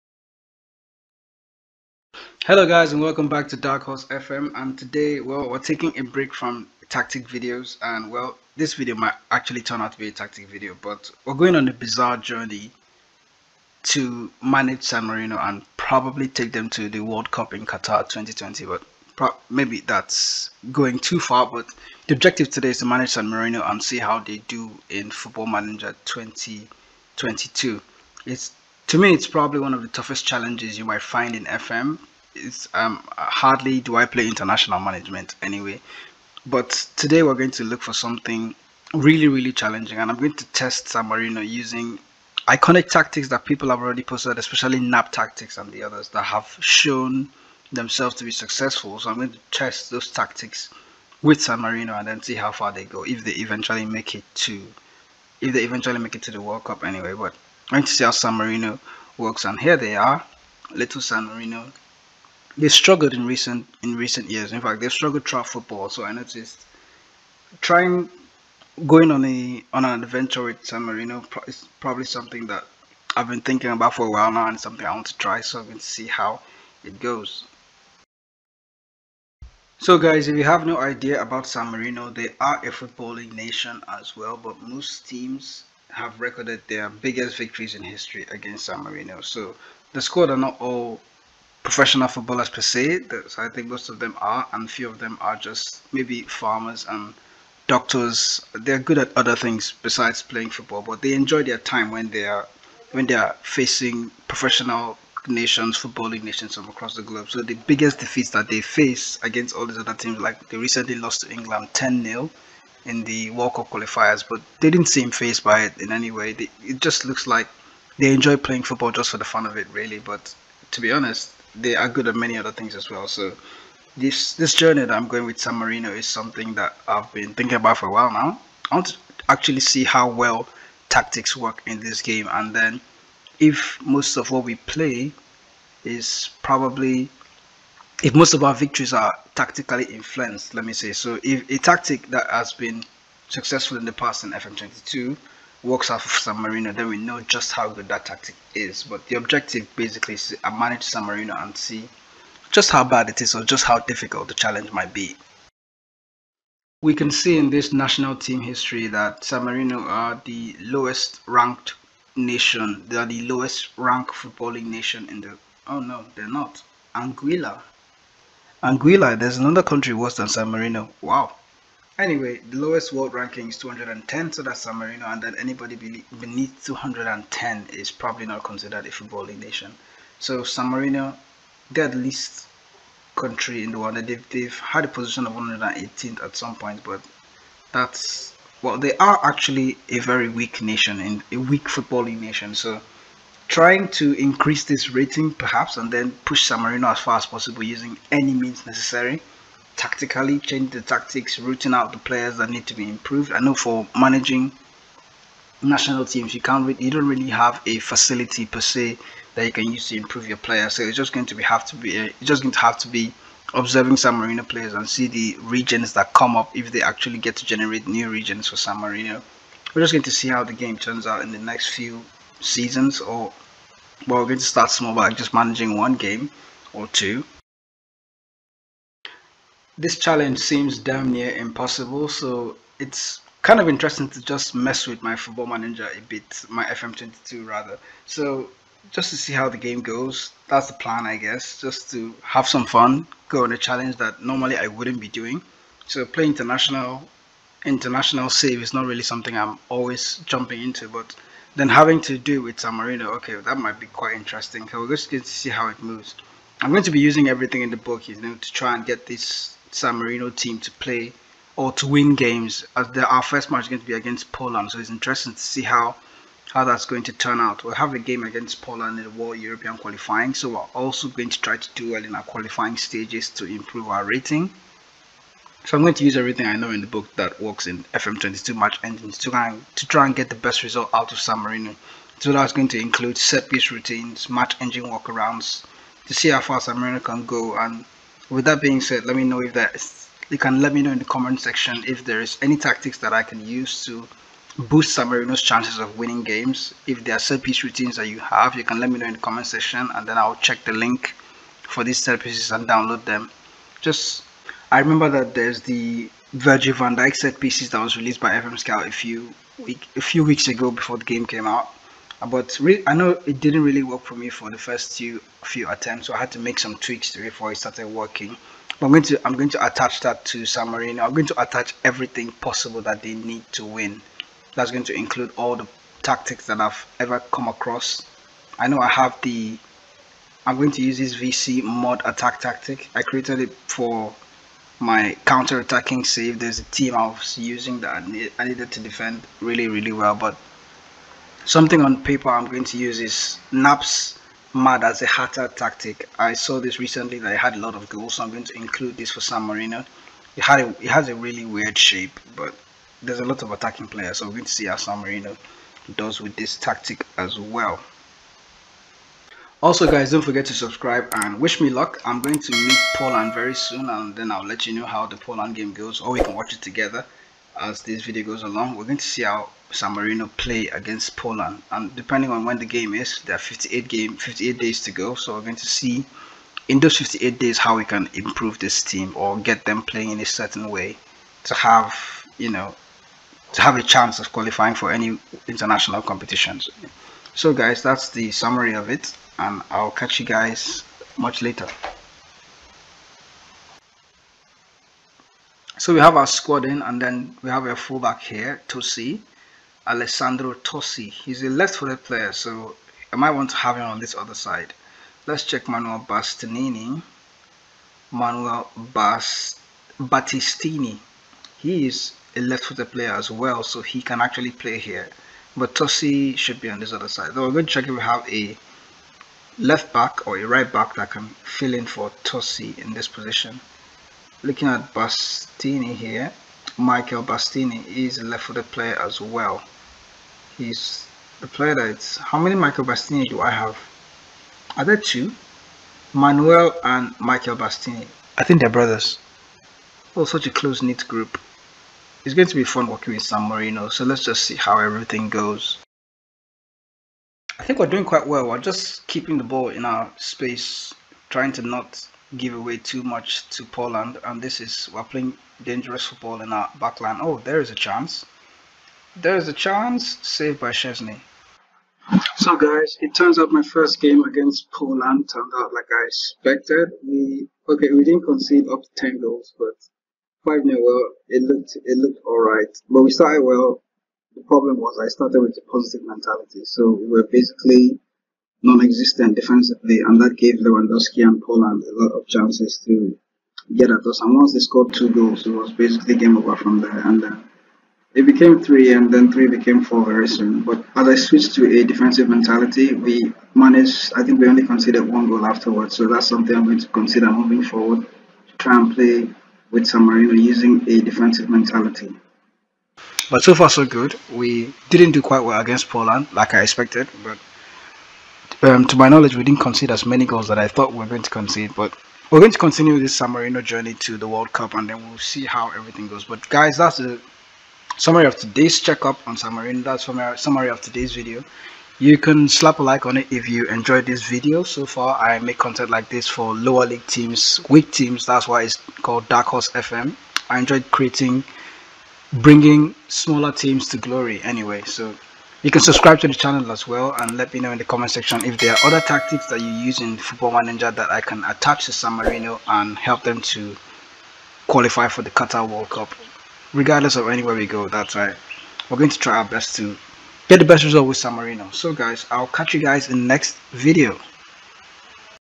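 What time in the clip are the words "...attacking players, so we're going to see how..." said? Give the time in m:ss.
5:53.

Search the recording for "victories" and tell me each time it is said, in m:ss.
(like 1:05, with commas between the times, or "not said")
1:27, 2:18.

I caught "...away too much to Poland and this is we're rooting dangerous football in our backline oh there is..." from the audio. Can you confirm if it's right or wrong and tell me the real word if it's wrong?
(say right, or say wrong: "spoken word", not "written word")
wrong: "playing", not "rooting".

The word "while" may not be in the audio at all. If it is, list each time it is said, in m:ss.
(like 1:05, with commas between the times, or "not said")
1:14, 2:07.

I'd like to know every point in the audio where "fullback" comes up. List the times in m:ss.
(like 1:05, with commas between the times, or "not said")
6:37.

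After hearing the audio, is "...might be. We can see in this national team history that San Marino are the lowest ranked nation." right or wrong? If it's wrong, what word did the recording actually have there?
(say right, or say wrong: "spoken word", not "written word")
right.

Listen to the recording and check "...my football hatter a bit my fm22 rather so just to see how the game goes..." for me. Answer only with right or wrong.
wrong.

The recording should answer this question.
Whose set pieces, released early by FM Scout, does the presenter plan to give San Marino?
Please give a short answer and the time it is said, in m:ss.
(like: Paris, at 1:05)
Virgil van Dijk, at 5:06.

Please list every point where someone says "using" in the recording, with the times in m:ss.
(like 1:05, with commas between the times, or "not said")
0:41, 3:17, 4:16, 5:37, 8:20.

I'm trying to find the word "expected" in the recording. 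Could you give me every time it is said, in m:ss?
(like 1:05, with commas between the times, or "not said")
7:46, 8:26.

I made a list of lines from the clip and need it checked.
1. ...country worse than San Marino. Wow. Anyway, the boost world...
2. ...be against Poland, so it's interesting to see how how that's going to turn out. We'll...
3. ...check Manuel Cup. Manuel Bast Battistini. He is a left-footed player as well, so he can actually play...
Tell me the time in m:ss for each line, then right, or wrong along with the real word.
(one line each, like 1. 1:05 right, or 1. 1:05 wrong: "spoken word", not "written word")
1. 2:49 wrong: "lowest", not "boost"
2. 4:23 right
3. 6:45 wrong: "Bastinini", not "Cup".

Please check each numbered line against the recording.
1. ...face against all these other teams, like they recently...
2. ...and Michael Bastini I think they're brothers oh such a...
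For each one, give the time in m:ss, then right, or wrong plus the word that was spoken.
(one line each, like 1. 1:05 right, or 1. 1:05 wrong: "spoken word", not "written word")
1. 1:48 right
2. 7:16 right.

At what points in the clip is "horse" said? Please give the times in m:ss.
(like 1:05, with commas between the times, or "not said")
0:03, 8:49.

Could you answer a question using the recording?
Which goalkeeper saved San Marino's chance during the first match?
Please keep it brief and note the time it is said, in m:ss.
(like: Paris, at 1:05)
Szczesny, at 7:40.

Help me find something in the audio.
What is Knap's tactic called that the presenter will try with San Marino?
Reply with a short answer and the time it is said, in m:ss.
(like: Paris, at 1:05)
MAD as a hatter, at 5:44.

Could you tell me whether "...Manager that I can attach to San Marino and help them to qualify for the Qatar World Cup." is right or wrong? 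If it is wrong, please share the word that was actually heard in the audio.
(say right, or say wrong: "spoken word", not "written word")
right.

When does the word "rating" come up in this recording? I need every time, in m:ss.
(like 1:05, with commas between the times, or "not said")
3:14, 4:34.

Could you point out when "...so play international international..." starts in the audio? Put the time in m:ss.
4:05.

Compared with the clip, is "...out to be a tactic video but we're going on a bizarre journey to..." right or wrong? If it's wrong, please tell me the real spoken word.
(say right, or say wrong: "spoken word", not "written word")
right.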